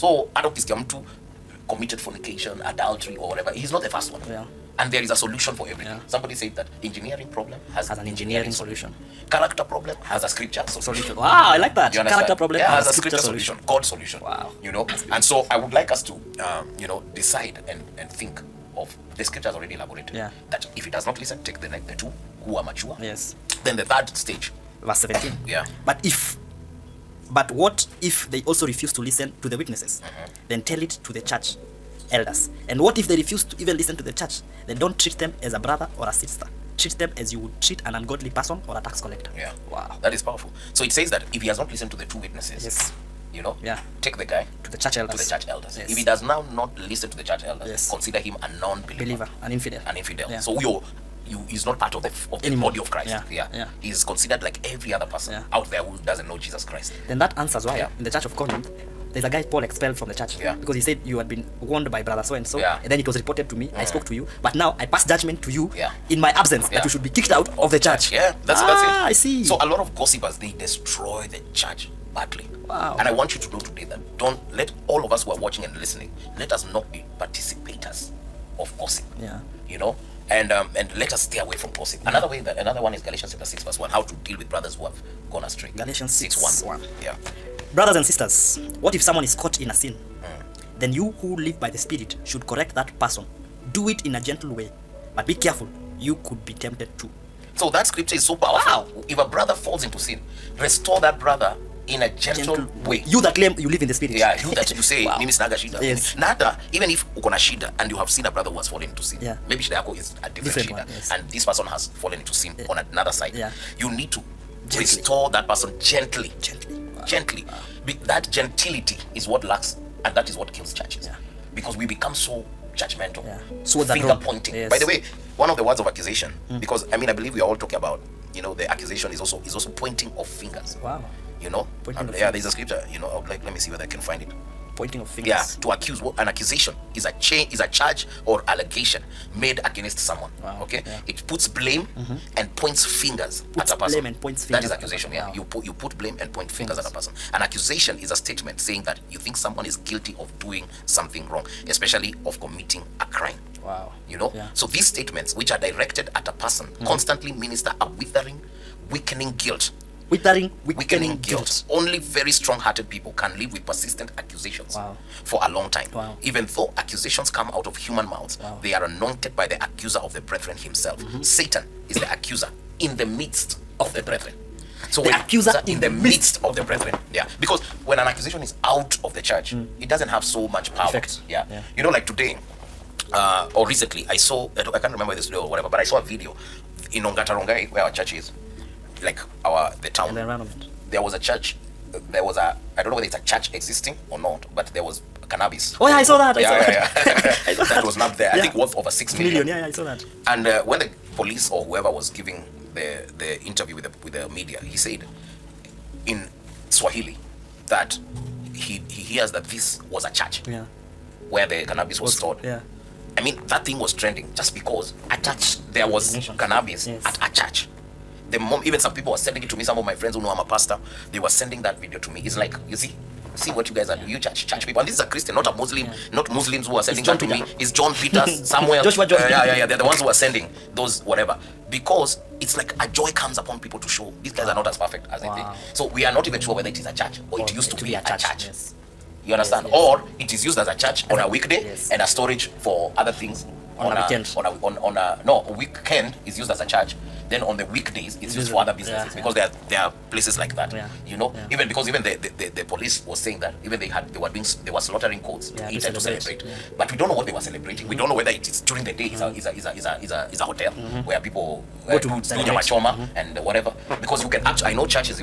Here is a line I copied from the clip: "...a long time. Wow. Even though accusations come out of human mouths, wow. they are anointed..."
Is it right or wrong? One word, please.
right.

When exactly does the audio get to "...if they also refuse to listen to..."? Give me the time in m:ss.
0:28.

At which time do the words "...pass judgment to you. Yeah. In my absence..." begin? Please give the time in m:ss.
1:04.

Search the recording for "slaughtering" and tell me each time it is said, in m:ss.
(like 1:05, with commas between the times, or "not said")
4:14.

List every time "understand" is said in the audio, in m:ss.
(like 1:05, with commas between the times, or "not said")
0:11, 3:59.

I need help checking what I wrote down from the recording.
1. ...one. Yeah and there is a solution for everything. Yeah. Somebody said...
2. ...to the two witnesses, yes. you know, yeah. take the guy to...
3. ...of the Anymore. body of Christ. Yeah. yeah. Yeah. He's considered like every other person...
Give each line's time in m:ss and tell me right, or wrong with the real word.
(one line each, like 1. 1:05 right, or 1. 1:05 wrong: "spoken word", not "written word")
1. 0:04 right
2. 0:41 right
3. 0:52 right.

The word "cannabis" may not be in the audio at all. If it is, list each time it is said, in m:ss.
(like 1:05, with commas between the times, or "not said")
3:15, 3:31, 3:36.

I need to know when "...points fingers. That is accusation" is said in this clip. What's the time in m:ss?
2:24.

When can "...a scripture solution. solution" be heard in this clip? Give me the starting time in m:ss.
0:10.